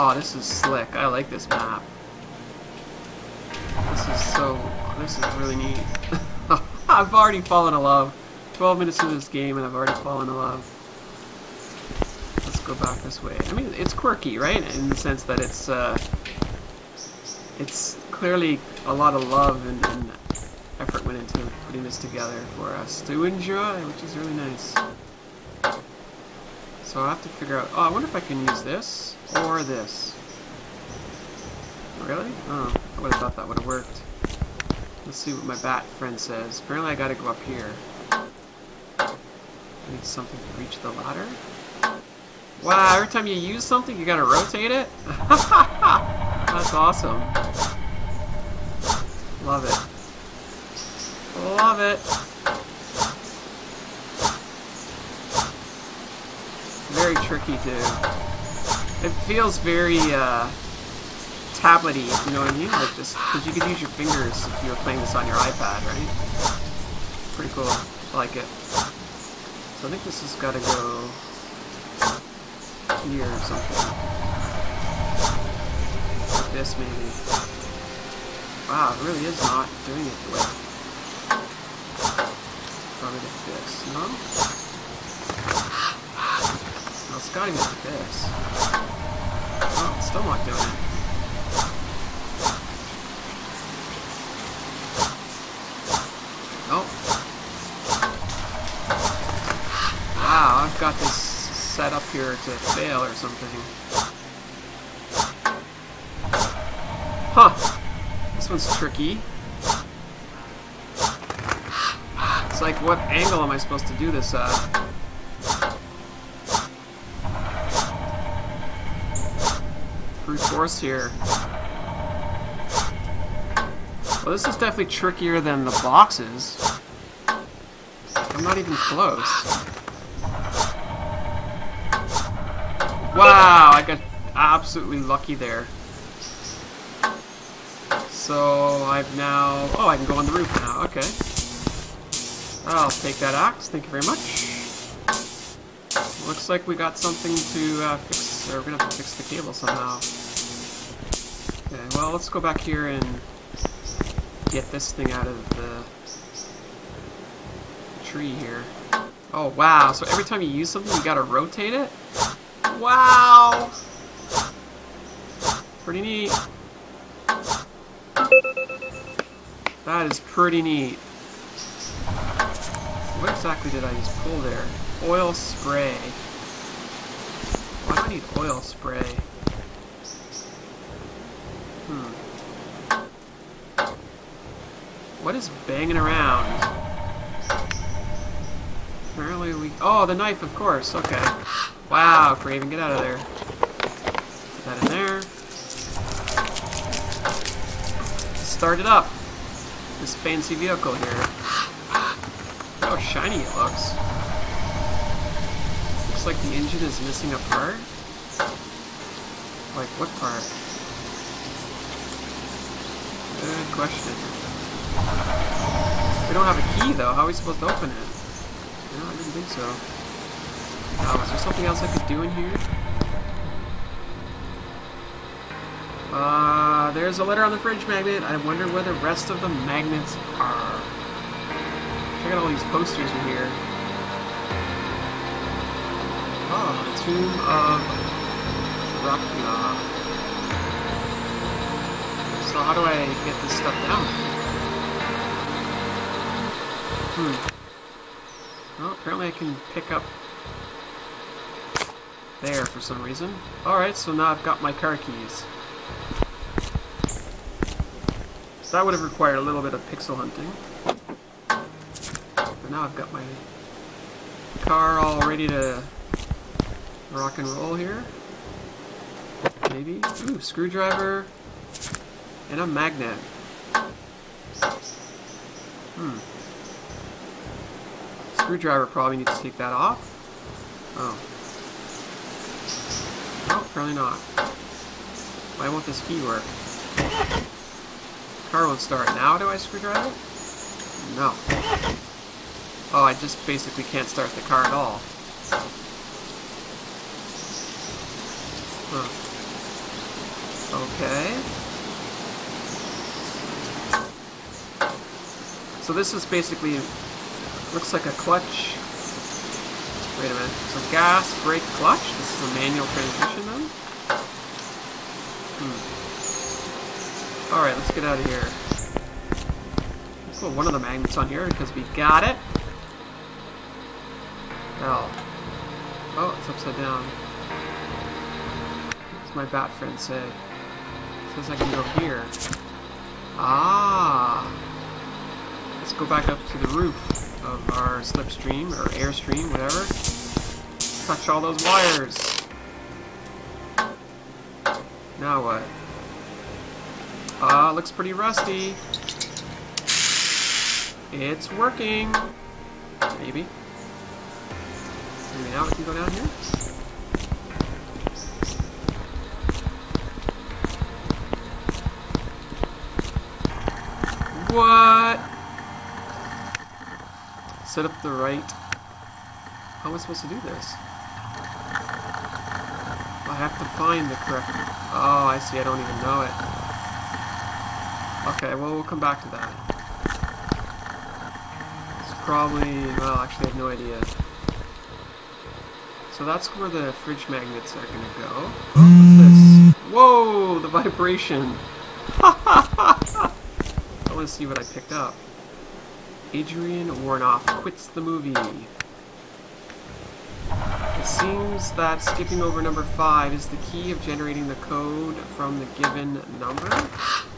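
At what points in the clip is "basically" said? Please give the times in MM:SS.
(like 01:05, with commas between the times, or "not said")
04:53, 05:06.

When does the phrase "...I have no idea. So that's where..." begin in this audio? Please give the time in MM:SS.
06:23.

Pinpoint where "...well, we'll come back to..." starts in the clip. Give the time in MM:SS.
06:18.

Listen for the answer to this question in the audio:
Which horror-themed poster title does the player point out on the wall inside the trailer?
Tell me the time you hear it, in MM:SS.
03:56.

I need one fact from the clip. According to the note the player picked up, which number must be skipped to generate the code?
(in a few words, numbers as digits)
5.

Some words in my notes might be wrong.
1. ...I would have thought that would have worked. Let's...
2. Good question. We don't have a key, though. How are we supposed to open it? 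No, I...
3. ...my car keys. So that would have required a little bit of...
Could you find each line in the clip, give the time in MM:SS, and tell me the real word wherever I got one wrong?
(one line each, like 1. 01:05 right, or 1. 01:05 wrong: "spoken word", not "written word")
1. 00:32 right
2. 03:33 right
3. 04:14 right.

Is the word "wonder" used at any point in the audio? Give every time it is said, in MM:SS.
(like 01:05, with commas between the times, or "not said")
00:27, 03:48.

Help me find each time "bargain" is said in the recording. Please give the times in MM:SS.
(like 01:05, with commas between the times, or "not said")
not said.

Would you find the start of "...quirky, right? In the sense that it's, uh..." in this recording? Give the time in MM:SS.
00:13.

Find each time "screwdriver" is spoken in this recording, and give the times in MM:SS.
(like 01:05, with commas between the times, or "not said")
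04:30, 04:38, 04:49.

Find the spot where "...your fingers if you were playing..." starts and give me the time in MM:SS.
01:03.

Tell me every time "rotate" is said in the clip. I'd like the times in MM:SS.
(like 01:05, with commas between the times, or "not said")
00:44, 02:41.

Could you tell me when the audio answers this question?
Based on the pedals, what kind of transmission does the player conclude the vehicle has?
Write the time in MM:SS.
05:12.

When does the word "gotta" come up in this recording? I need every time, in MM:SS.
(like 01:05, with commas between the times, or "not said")
00:36, 00:44, 01:27.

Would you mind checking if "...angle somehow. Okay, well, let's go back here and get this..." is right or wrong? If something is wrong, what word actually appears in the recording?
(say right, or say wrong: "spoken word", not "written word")
wrong: "cable", not "angle".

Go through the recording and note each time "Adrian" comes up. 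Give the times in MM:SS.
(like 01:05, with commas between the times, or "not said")
06:36.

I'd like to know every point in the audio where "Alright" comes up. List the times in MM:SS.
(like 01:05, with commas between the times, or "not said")
04:13, 05:17.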